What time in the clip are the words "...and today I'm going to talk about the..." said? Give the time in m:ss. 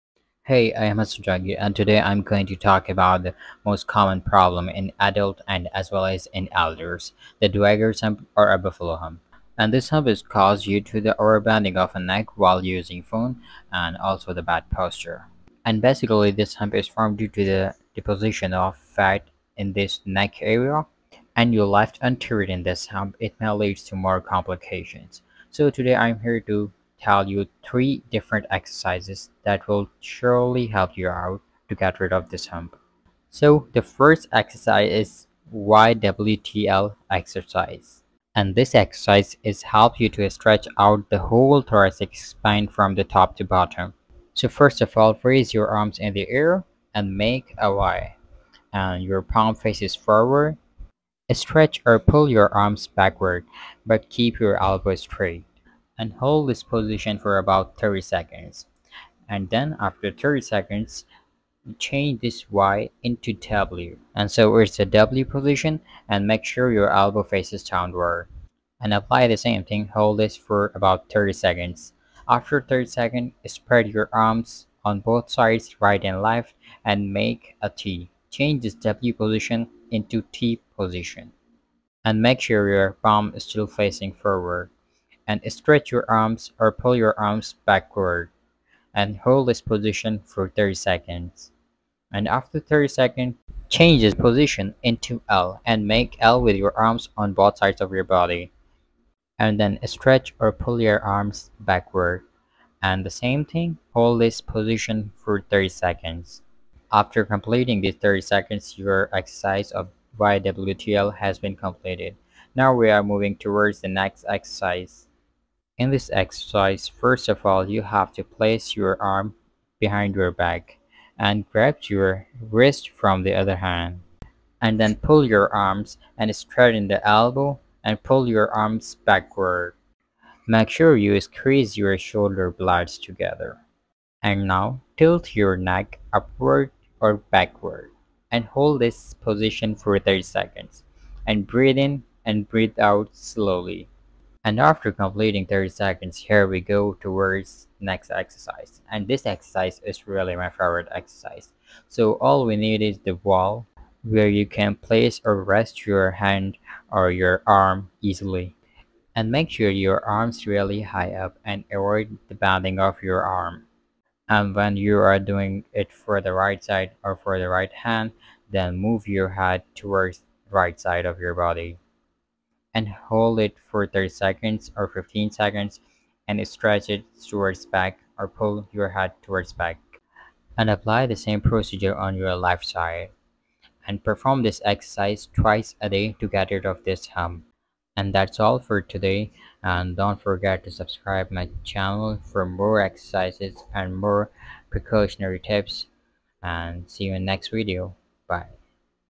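0:01.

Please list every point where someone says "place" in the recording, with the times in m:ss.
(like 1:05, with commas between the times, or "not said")
1:58, 2:34.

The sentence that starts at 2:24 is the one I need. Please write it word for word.
And after completing 30 seconds, here we go towards next exercise.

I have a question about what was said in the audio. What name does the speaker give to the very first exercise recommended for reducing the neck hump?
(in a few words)
YWTL exercise.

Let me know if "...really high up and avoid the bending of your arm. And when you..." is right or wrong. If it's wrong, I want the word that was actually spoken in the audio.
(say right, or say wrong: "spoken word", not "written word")
right.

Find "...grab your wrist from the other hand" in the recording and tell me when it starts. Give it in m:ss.
2:01.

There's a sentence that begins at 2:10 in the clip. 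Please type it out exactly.
Make sure you squeeze your shoulder blades together.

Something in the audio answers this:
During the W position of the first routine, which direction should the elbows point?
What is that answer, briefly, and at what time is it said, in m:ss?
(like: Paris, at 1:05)
Downward, at 1:06.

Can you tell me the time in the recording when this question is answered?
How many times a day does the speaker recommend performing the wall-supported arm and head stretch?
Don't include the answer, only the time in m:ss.
3:05.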